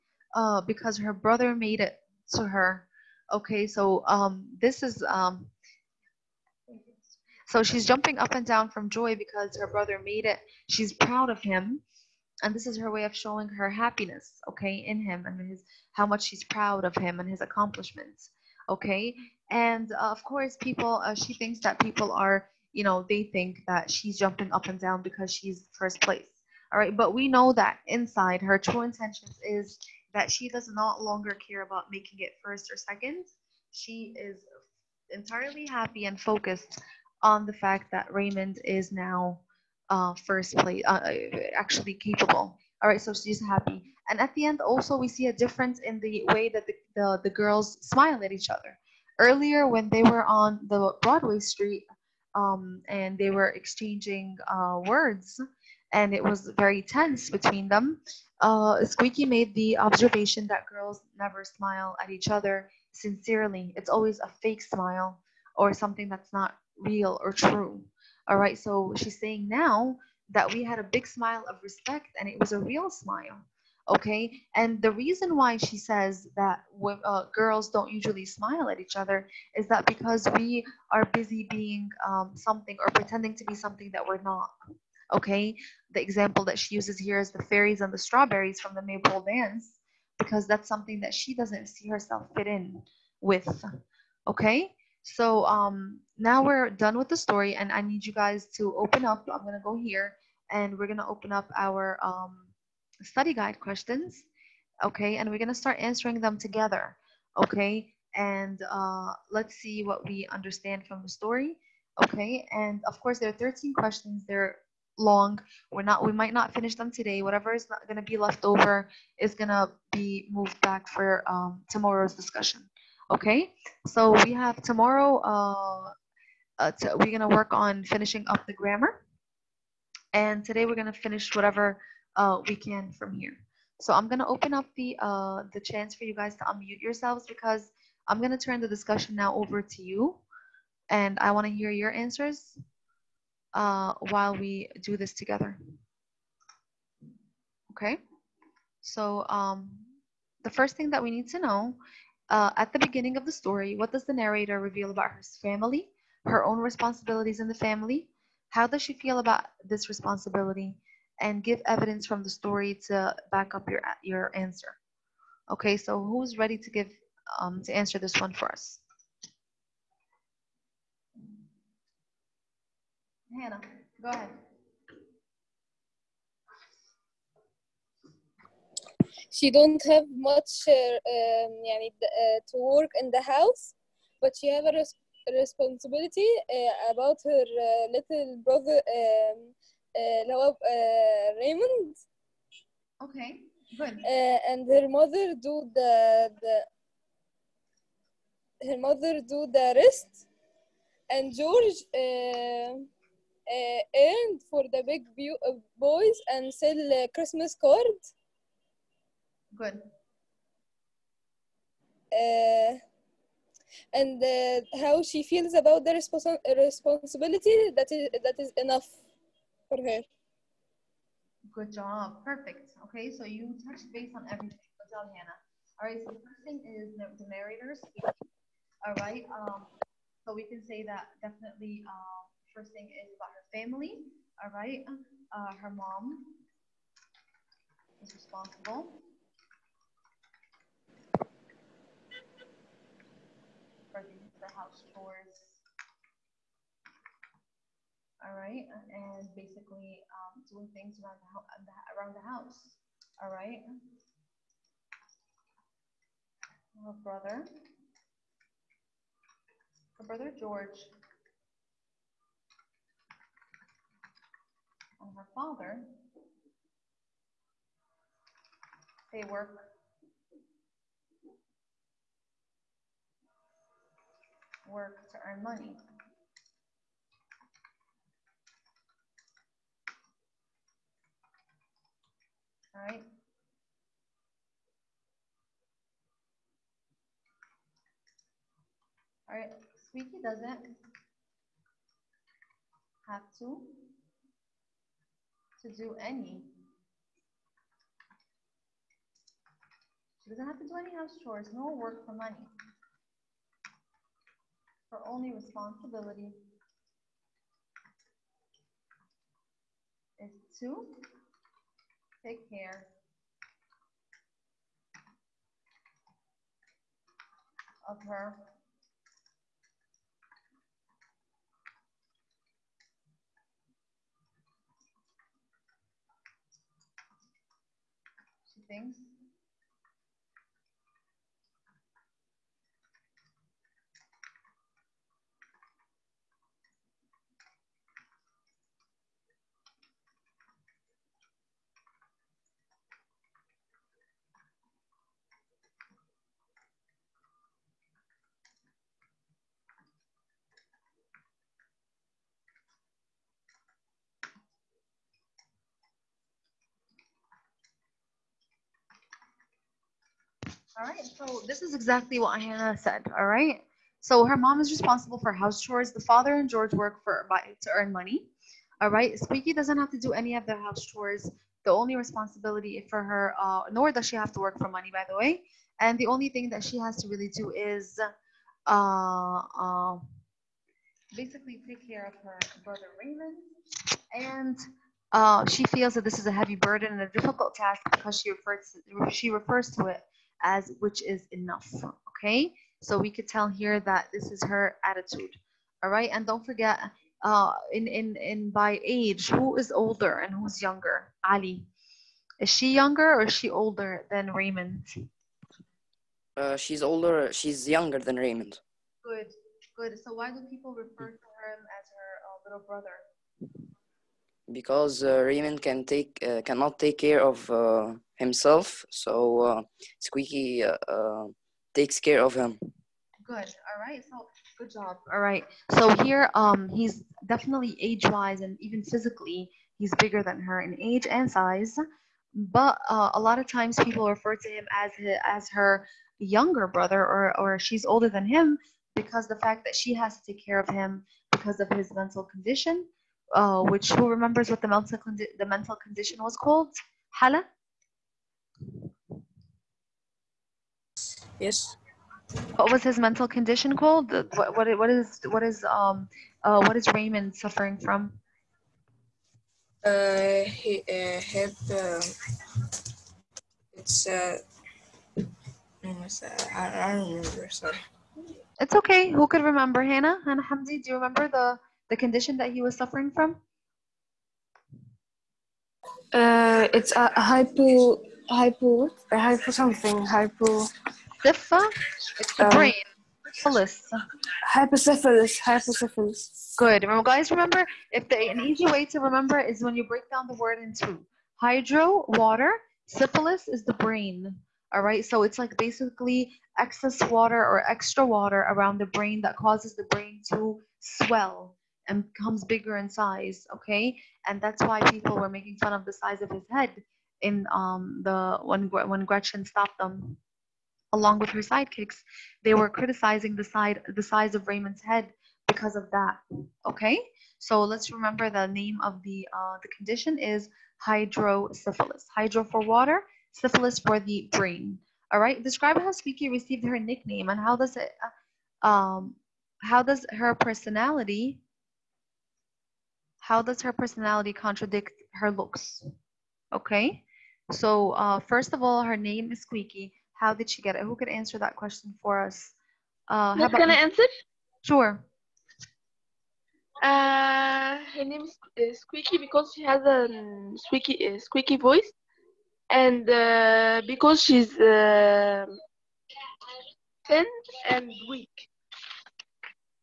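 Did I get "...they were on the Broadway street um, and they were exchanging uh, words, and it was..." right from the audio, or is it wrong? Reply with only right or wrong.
right.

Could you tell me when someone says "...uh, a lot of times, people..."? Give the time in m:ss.
7:12.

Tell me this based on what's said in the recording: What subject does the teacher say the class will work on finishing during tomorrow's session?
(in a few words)
Grammar.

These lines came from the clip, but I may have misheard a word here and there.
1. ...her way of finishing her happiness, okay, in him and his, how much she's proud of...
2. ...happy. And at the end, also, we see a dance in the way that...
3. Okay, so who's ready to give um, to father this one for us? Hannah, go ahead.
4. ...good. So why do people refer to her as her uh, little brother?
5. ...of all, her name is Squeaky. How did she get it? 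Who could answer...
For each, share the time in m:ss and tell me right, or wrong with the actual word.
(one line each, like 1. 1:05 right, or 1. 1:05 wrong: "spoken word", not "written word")
1. 0:12 wrong: "showing", not "finishing"
2. 0:43 wrong: "difference", not "dance"
3. 2:45 wrong: "answer", not "father"
4. 6:49 right
5. 8:58 right.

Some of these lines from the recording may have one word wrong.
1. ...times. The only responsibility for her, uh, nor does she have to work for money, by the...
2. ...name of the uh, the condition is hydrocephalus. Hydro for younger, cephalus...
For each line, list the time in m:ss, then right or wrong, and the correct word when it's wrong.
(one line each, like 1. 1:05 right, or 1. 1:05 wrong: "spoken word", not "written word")
1. 6:10 wrong: "chores", not "times"
2. 8:38 wrong: "water", not "younger".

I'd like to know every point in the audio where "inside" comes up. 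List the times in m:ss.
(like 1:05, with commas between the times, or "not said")
0:27.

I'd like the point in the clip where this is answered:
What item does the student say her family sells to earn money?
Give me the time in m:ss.
3:27.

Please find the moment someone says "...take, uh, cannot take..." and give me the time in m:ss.
6:55.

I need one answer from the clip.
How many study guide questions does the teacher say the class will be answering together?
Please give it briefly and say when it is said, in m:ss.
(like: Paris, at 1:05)
13, at 1:53.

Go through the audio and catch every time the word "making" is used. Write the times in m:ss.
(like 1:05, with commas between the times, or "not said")
0:31, 8:25.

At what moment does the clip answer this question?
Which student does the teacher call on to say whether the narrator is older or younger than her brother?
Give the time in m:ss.
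6:41.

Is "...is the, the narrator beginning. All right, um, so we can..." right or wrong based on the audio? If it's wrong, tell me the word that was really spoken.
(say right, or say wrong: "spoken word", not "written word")
wrong: "speaking", not "beginning".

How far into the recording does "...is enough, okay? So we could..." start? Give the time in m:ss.
6:31.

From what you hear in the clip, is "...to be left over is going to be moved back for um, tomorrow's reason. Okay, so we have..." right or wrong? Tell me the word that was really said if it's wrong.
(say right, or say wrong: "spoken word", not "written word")
wrong: "discussion", not "reason".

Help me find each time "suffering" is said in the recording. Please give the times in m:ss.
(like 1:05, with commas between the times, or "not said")
7:37, 7:52.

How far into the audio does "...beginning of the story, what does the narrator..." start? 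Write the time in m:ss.
2:32.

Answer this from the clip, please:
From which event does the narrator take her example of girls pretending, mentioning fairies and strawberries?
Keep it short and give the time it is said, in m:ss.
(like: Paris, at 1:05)
Maypole dance, at 1:28.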